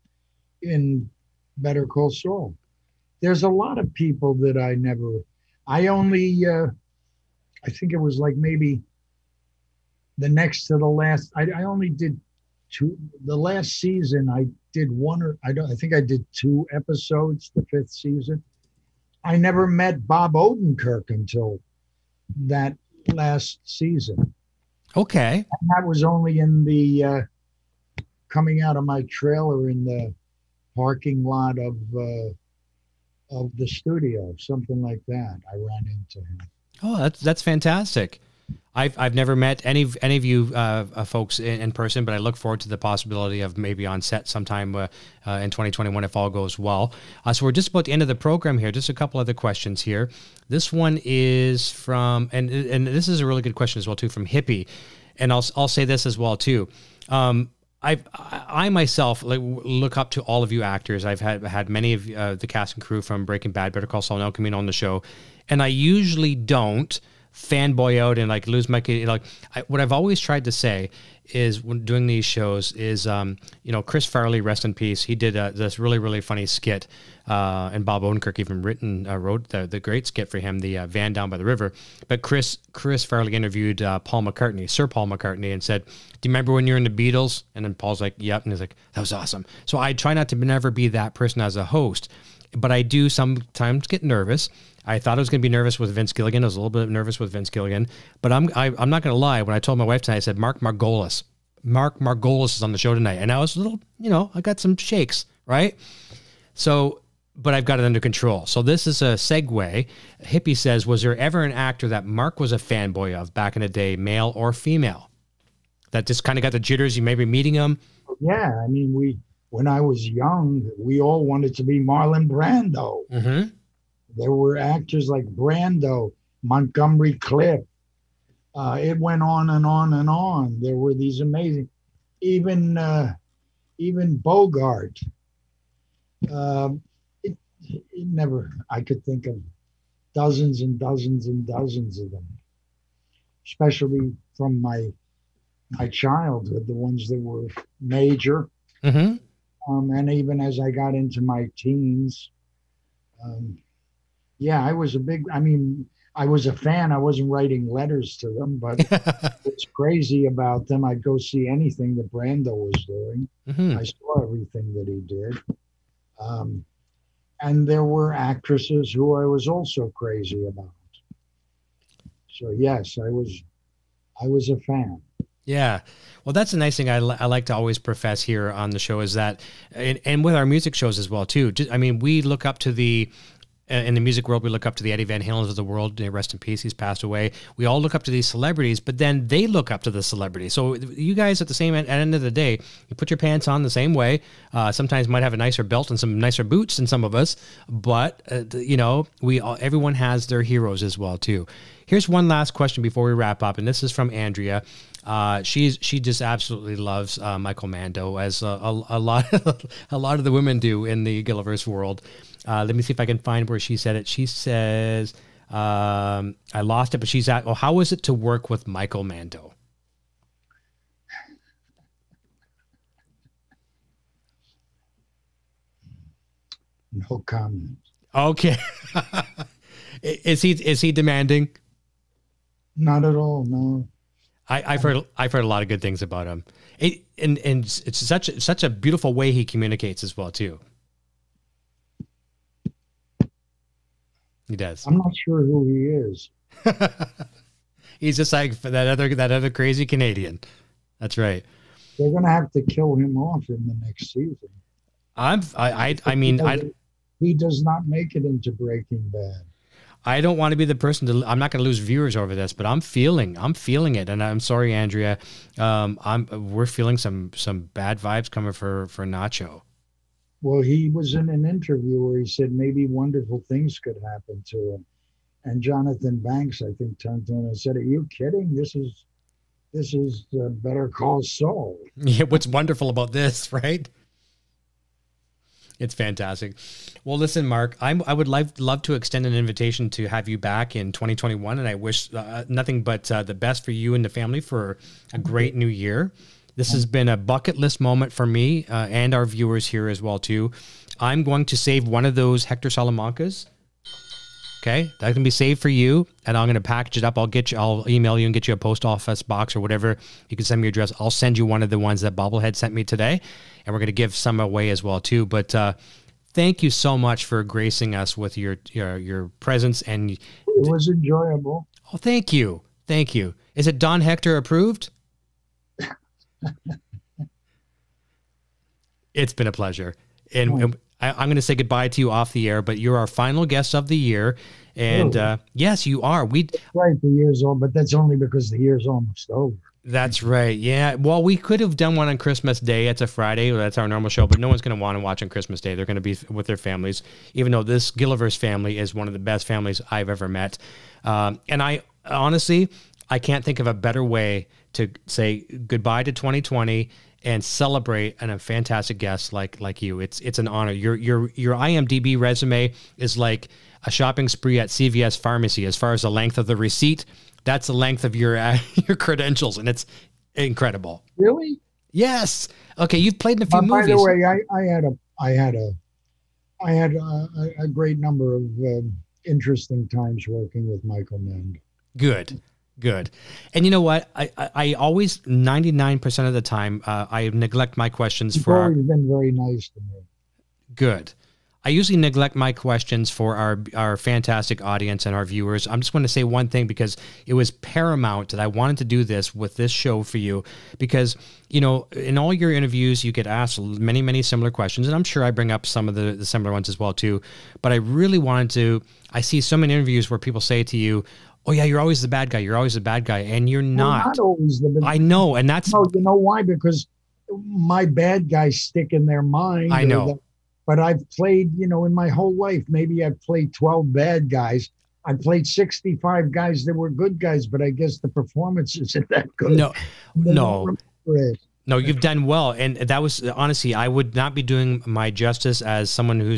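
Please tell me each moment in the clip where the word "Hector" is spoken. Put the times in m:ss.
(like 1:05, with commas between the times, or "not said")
5:02, 5:24.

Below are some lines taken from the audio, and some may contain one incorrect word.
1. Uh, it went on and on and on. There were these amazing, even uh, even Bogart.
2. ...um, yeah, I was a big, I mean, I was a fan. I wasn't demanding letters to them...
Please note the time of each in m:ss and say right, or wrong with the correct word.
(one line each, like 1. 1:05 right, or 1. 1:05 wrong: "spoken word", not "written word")
1. 2:08 right
2. 2:33 wrong: "writing", not "demanding".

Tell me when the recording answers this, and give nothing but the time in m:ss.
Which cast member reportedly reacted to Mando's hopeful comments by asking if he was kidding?
4:35.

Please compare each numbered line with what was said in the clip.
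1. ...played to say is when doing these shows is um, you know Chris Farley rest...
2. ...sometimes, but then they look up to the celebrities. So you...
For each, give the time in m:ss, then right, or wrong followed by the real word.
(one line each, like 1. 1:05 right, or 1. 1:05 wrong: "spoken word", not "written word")
1. 1:10 wrong: "tried", not "played"
2. 3:08 wrong: "celebrities", not "sometimes".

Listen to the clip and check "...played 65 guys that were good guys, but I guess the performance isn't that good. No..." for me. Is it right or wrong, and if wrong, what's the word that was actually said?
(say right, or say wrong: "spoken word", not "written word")
right.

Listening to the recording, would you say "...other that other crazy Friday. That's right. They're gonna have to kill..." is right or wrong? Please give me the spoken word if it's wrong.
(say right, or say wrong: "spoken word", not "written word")
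wrong: "Canadian", not "Friday".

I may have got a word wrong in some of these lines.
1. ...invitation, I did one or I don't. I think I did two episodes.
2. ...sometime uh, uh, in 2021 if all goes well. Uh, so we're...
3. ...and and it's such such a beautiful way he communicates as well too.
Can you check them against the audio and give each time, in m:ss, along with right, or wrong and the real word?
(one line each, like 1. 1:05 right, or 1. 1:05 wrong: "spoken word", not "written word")
1. 0:13 wrong: "season", not "invitation"
2. 0:44 right
3. 3:57 right.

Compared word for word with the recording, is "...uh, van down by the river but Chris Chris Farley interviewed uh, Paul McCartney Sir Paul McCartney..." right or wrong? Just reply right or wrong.
right.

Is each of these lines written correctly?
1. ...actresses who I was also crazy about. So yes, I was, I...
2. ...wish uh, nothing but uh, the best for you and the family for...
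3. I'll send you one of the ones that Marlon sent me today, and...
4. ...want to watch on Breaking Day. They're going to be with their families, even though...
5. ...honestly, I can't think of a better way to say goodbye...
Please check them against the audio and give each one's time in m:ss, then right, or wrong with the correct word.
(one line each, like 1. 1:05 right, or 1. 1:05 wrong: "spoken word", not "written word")
1. 2:48 right
2. 4:51 right
3. 5:10 wrong: "Bobblehead", not "Marlon"
4. 5:44 wrong: "Christmas", not "Breaking"
5. 5:52 right.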